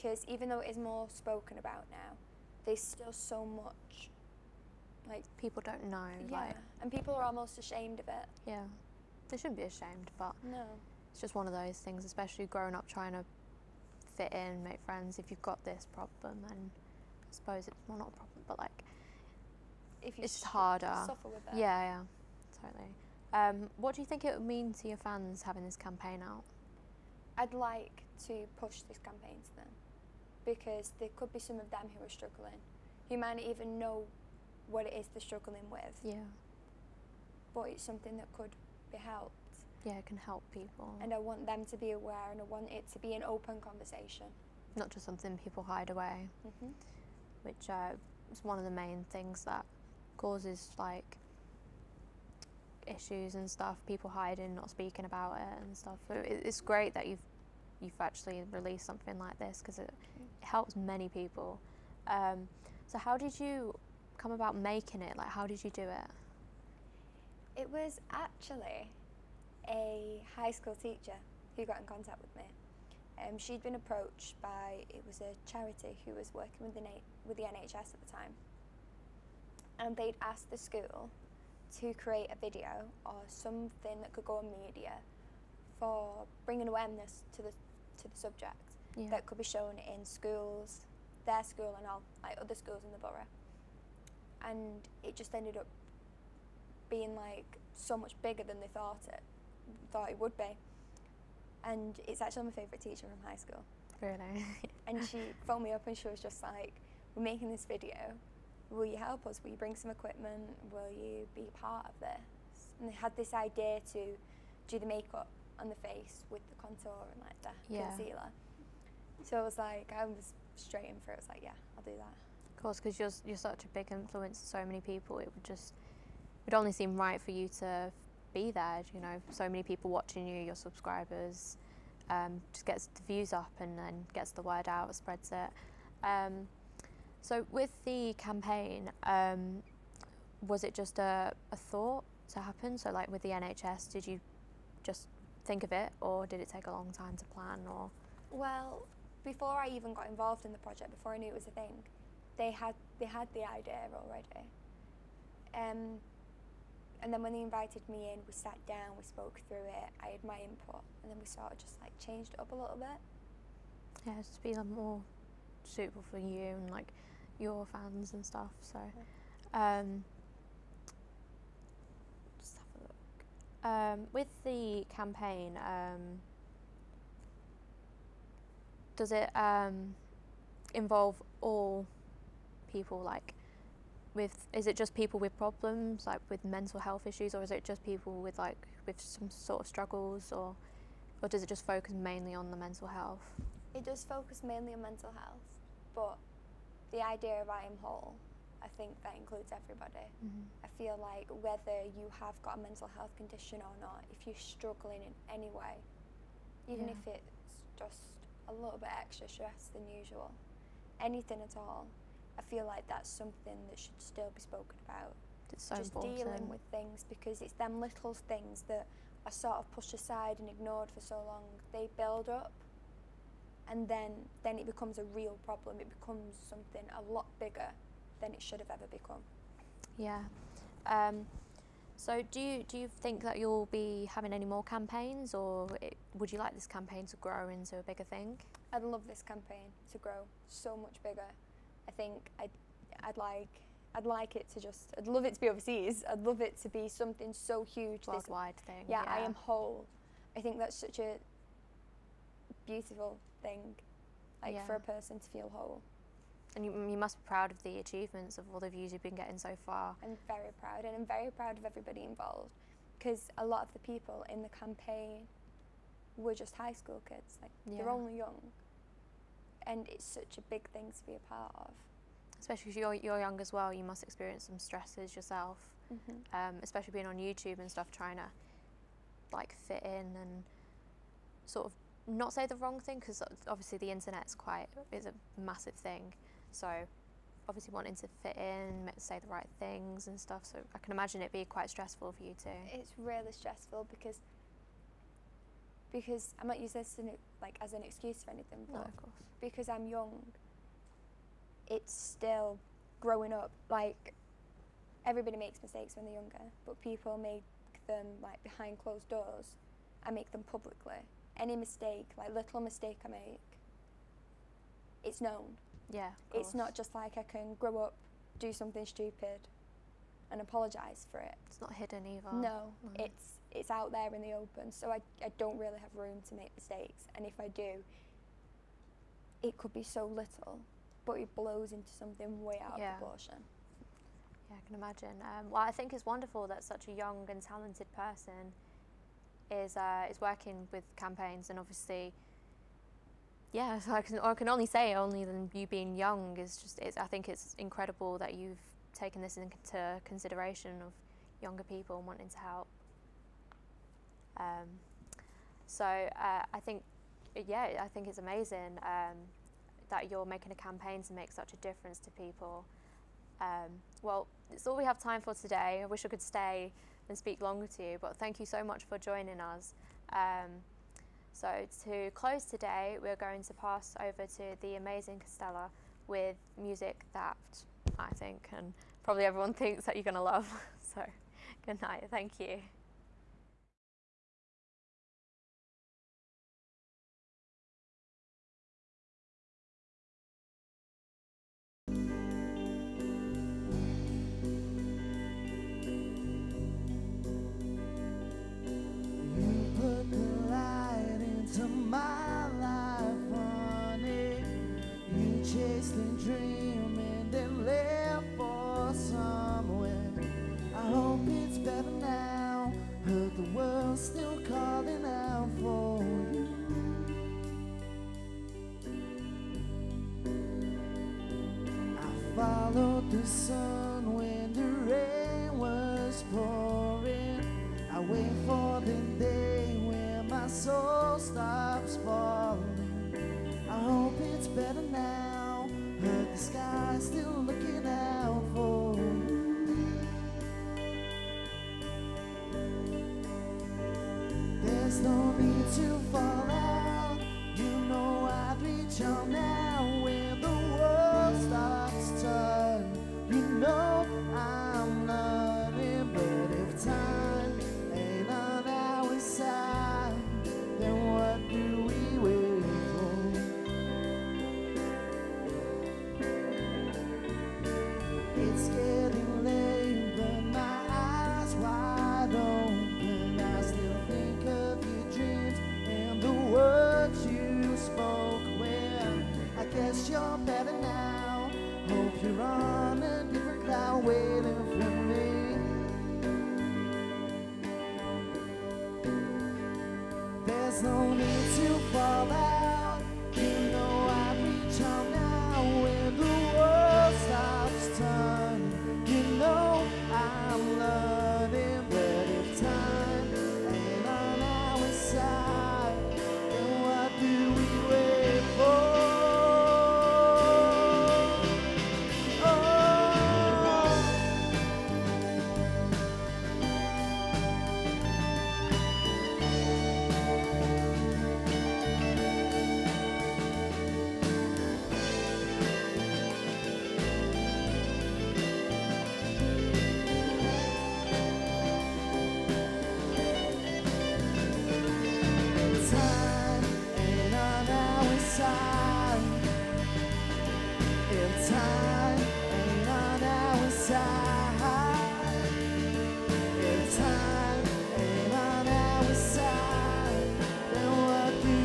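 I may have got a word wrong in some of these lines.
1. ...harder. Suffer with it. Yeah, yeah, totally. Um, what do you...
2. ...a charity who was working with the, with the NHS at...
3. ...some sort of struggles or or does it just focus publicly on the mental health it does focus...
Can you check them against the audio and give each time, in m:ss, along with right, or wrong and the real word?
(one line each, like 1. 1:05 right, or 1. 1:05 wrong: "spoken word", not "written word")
1. 0:20 right
2. 1:15 right
3. 3:09 wrong: "mainly", not "publicly".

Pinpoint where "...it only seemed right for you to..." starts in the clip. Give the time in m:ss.
2:06.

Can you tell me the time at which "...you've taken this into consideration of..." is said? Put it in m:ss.
5:48.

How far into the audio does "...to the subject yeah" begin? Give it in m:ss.
1:28.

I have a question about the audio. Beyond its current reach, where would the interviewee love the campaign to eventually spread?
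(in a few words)
Overseas.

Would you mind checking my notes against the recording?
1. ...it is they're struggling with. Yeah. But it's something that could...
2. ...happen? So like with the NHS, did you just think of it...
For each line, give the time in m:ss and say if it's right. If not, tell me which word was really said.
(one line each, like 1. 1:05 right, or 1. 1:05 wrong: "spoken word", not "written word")
1. 0:34 right
2. 2:22 right.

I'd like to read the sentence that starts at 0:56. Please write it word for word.
So it's great that you've you've actually released something like this because it, it, mm.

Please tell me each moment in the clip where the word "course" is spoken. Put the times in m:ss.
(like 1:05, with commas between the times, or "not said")
2:02, 4:58.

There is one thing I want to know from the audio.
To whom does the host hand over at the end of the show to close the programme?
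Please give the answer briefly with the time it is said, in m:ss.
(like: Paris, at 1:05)
Castella, at 6:15.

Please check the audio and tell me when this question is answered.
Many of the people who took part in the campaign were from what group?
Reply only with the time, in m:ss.
4:26.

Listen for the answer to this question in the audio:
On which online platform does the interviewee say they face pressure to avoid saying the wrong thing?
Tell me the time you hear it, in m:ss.
4:37.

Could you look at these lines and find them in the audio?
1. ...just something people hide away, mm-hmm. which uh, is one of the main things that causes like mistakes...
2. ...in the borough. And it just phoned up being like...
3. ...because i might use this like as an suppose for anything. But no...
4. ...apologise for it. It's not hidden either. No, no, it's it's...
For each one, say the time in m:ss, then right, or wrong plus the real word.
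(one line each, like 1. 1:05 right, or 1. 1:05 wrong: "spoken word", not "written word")
1. 0:44 wrong: "issues", not "mistakes"
2. 1:32 wrong: "ended", not "phoned"
3. 4:55 wrong: "excuse", not "suppose"
4. 5:20 right.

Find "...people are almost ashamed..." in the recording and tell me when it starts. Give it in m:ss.
0:06.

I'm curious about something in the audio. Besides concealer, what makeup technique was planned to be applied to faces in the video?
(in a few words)
Contour.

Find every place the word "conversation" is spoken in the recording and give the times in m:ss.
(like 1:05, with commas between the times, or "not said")
0:43.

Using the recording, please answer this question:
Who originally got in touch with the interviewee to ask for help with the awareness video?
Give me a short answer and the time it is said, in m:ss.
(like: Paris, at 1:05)
A high school teacher, at 1:10.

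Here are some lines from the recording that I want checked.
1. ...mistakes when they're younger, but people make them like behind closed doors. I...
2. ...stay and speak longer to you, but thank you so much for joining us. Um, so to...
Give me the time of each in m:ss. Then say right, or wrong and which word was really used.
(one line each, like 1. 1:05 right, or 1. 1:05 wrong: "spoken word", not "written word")
1. 5:05 right
2. 6:06 right.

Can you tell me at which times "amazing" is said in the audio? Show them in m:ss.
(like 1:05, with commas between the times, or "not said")
5:58, 6:14.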